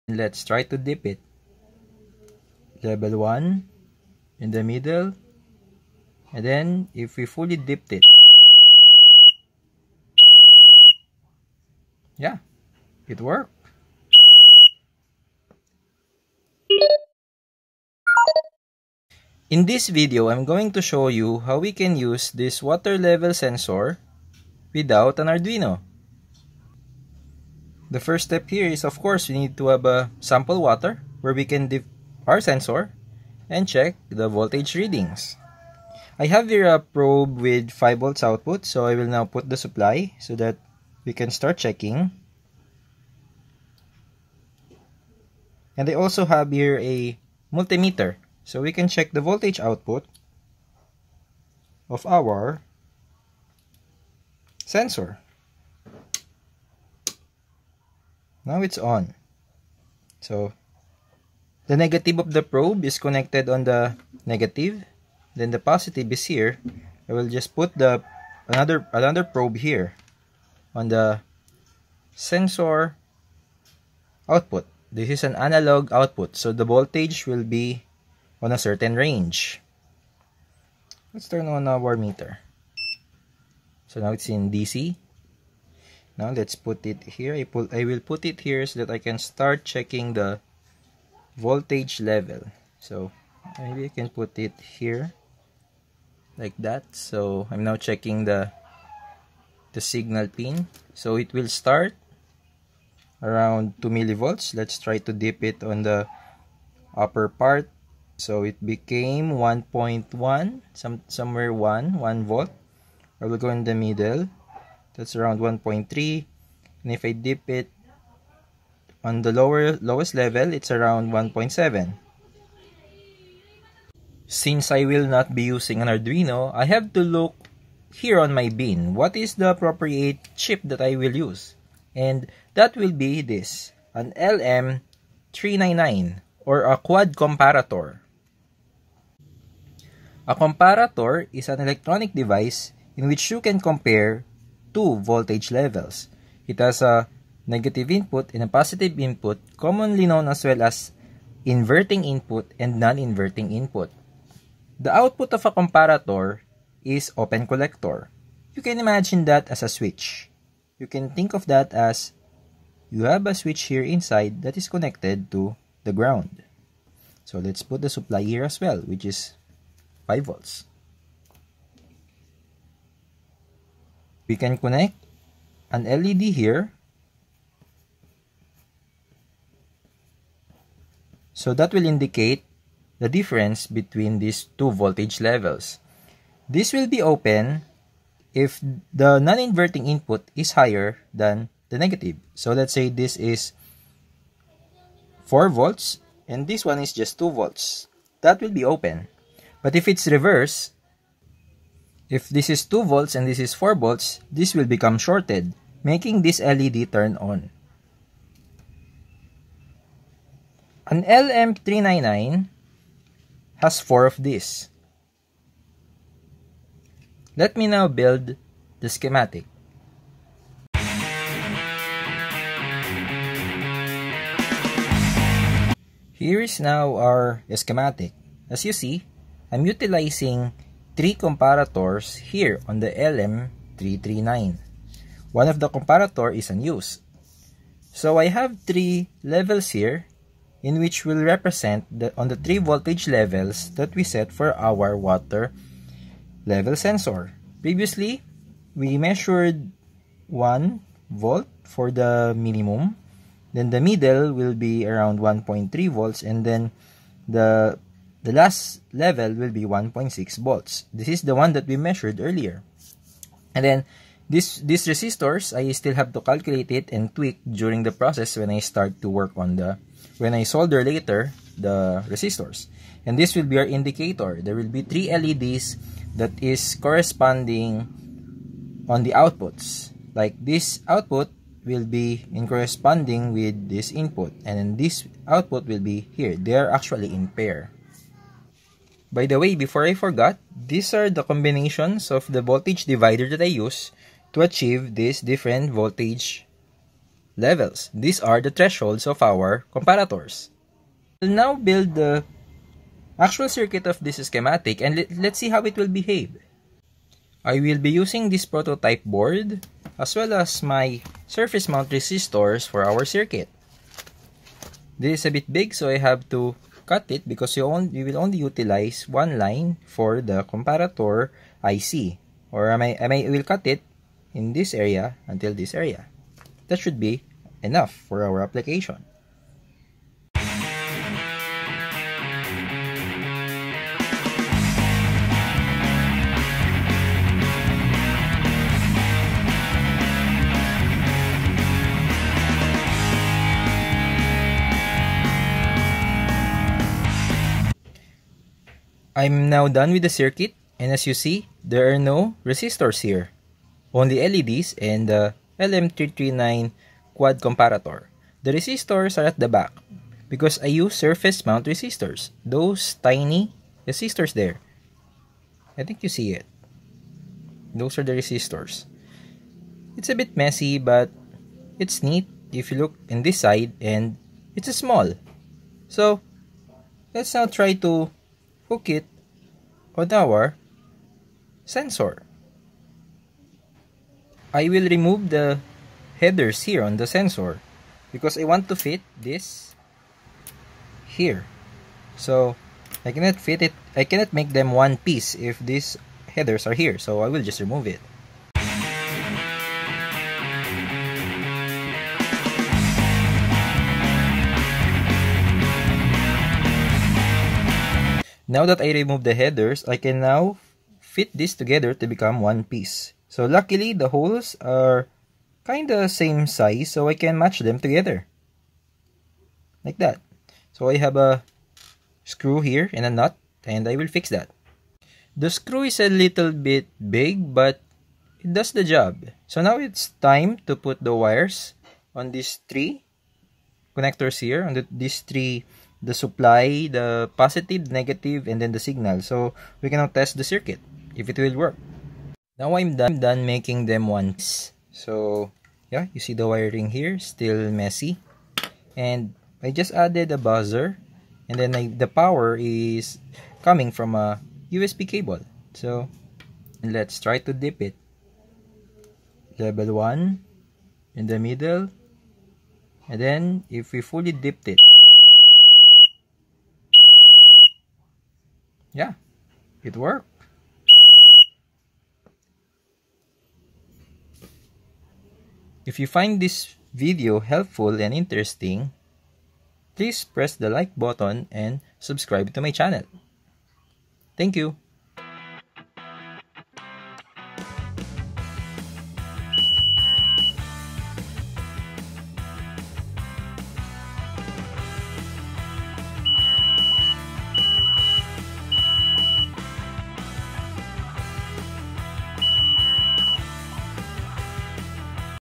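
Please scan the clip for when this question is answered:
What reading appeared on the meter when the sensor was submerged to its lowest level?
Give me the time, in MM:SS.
02:01.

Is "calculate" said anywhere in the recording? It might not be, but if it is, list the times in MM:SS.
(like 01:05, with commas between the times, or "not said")
04:26.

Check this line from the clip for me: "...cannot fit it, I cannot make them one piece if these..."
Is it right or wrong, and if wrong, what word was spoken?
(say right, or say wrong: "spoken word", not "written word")
right.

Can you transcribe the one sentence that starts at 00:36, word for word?
I have here a probe with 5 volts output so I will now put the supply so that we can start checking.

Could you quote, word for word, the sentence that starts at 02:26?
It has a negative input and a positive input, commonly known as well as inverting input and non-inverting input.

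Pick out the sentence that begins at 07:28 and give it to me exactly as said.
And I just added a buzzer and then I, the power is coming from a USB cable.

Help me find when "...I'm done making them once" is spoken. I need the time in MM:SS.
07:23.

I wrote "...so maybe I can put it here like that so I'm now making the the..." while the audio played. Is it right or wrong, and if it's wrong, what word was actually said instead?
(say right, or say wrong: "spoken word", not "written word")
wrong: "checking", not "making".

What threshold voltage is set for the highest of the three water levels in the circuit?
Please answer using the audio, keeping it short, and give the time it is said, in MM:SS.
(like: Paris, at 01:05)
1.6 volts, at 04:19.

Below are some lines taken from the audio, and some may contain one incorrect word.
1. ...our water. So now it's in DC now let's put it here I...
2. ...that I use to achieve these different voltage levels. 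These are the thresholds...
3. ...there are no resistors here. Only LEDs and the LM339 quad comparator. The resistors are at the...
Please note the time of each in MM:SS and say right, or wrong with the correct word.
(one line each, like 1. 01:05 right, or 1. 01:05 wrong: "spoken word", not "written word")
1. 01:21 wrong: "meter", not "water"
2. 04:53 right
3. 05:51 right.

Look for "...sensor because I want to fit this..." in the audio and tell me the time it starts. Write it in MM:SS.
06:27.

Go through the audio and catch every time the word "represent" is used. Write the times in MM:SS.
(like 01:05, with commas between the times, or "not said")
04:01.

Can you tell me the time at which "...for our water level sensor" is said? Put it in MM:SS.
04:04.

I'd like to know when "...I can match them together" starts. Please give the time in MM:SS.
06:57.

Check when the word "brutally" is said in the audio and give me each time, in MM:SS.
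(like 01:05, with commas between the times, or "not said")
not said.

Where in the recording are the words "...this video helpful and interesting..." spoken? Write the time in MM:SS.
07:56.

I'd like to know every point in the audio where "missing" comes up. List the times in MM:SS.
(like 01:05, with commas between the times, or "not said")
not said.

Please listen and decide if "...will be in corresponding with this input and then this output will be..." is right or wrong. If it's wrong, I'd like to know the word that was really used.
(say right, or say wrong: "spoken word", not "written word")
right.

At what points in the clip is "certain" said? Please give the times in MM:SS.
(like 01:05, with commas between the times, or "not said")
01:18.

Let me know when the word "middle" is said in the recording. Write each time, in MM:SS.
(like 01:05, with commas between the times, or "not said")
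00:04, 01:53, 04:13, 07:41.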